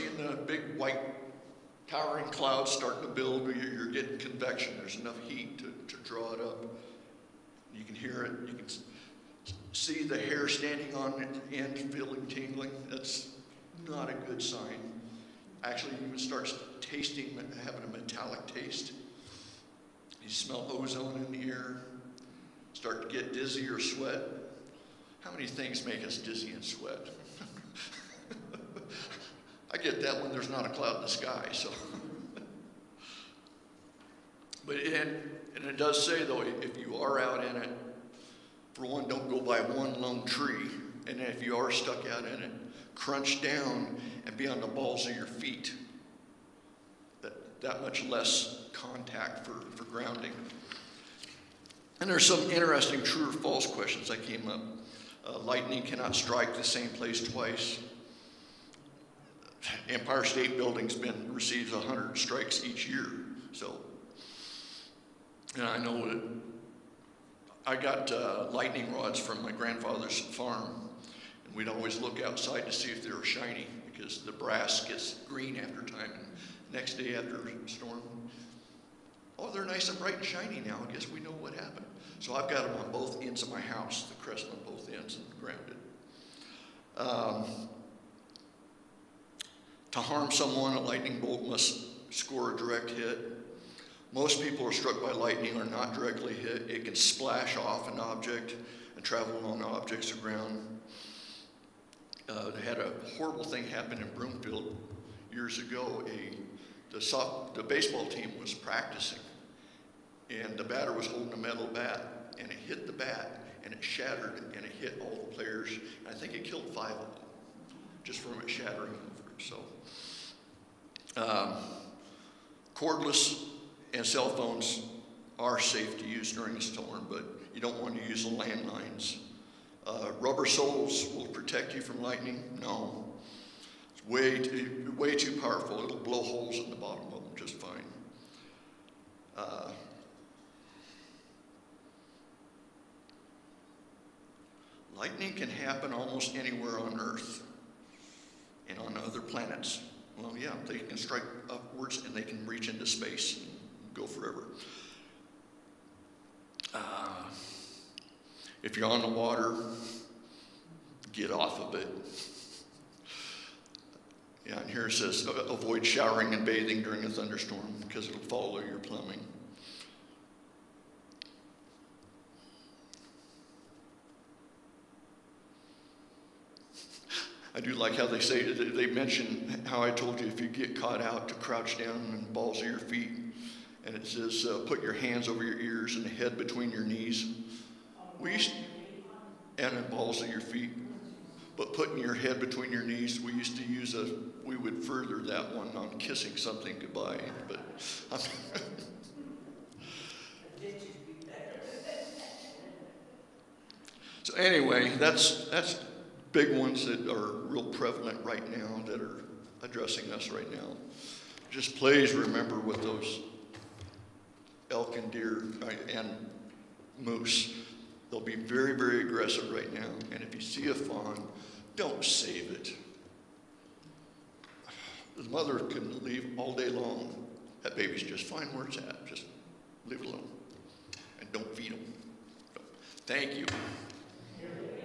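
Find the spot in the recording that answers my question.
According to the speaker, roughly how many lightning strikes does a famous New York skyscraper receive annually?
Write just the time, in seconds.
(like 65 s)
61 s.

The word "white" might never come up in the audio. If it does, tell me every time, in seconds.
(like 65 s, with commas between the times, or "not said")
0 s.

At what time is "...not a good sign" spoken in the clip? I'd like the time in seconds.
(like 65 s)
13 s.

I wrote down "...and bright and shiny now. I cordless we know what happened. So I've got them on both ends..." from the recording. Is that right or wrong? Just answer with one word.
wrong.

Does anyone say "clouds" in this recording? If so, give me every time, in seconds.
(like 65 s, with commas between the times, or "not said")
2 s, 30 s.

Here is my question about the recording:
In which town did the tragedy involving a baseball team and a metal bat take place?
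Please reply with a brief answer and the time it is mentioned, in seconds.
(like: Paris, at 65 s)
Broomfield, at 104 s.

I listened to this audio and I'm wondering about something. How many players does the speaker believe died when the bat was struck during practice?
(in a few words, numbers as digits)
5.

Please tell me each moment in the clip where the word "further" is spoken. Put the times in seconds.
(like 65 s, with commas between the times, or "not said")
194 s.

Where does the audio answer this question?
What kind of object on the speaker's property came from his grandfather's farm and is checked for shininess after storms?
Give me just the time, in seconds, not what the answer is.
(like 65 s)
68 s.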